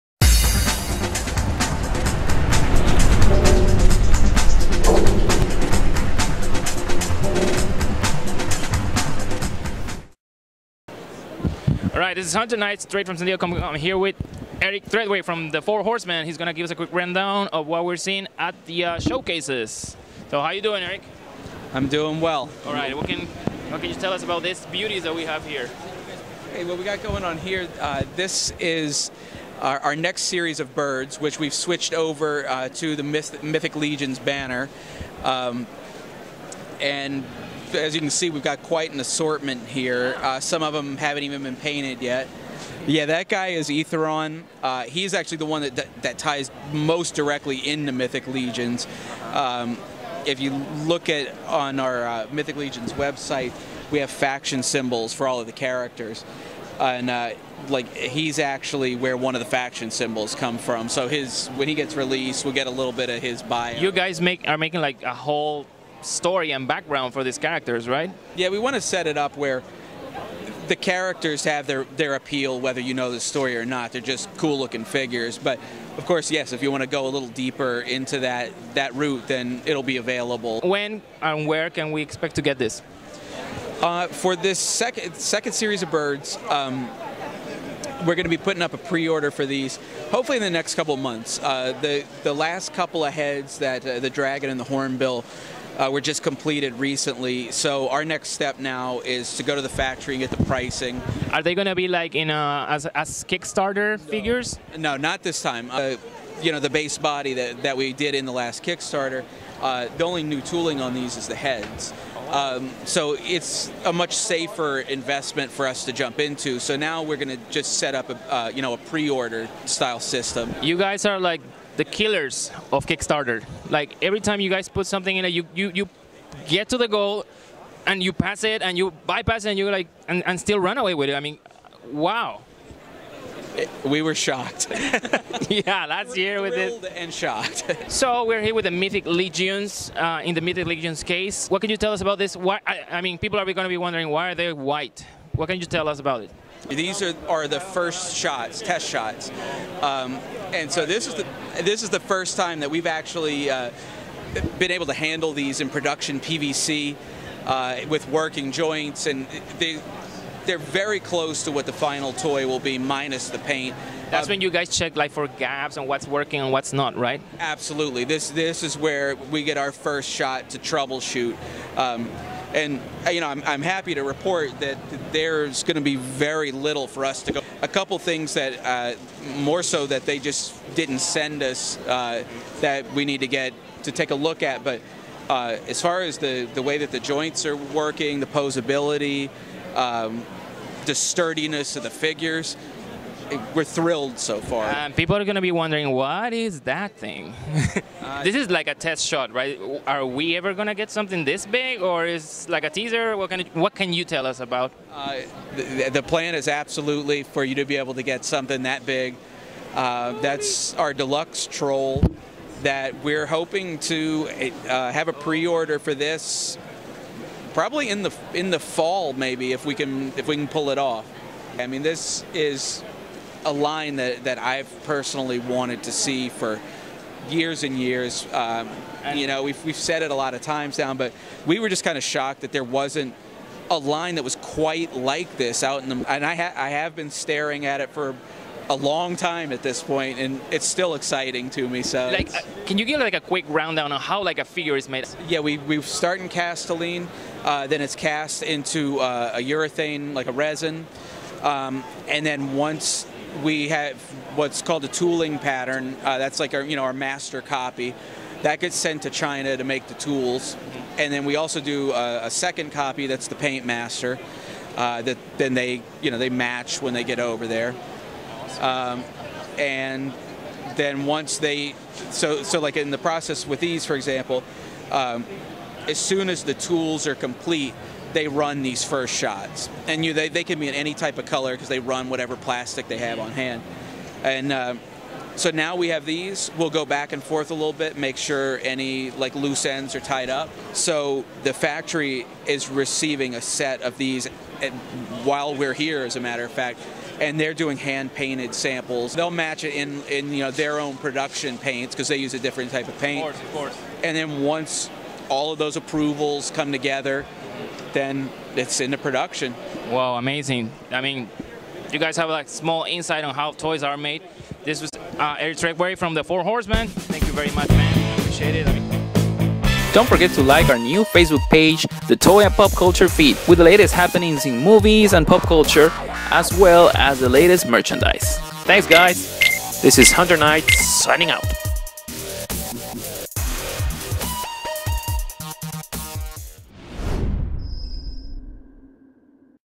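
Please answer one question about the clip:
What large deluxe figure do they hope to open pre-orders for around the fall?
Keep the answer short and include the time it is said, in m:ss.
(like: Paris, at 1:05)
Deluxe troll, at 3:30.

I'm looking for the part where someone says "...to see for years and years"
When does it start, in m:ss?
3:45.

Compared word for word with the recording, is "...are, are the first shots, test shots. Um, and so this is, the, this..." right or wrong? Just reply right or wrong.
right.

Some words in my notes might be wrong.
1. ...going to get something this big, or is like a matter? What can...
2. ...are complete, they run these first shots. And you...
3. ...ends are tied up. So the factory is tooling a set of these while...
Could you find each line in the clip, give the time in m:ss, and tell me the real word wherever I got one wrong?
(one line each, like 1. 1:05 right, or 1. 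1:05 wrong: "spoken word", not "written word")
1. 3:20 wrong: "teaser", not "matter"
2. 4:37 right
3. 4:49 wrong: "receiving", not "tooling".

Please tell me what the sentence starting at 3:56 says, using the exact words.
And I, ha I have been staring at it for a long time at this point, and it's still exciting to me.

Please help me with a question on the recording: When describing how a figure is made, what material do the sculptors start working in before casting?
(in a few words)
Castilene.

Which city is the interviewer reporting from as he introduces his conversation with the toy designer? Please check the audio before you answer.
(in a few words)
San Diego.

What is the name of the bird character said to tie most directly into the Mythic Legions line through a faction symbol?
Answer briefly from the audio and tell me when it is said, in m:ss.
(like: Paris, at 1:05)
Eathyron, at 0:43.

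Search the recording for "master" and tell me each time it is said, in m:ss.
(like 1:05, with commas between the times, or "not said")
4:16, 4:23.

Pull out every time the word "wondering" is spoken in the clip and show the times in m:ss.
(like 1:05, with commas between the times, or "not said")
2:23, 3:15.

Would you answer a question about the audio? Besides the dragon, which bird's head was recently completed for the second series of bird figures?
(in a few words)
Hornbill.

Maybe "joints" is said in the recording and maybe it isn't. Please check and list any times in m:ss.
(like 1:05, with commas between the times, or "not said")
2:38, 3:06.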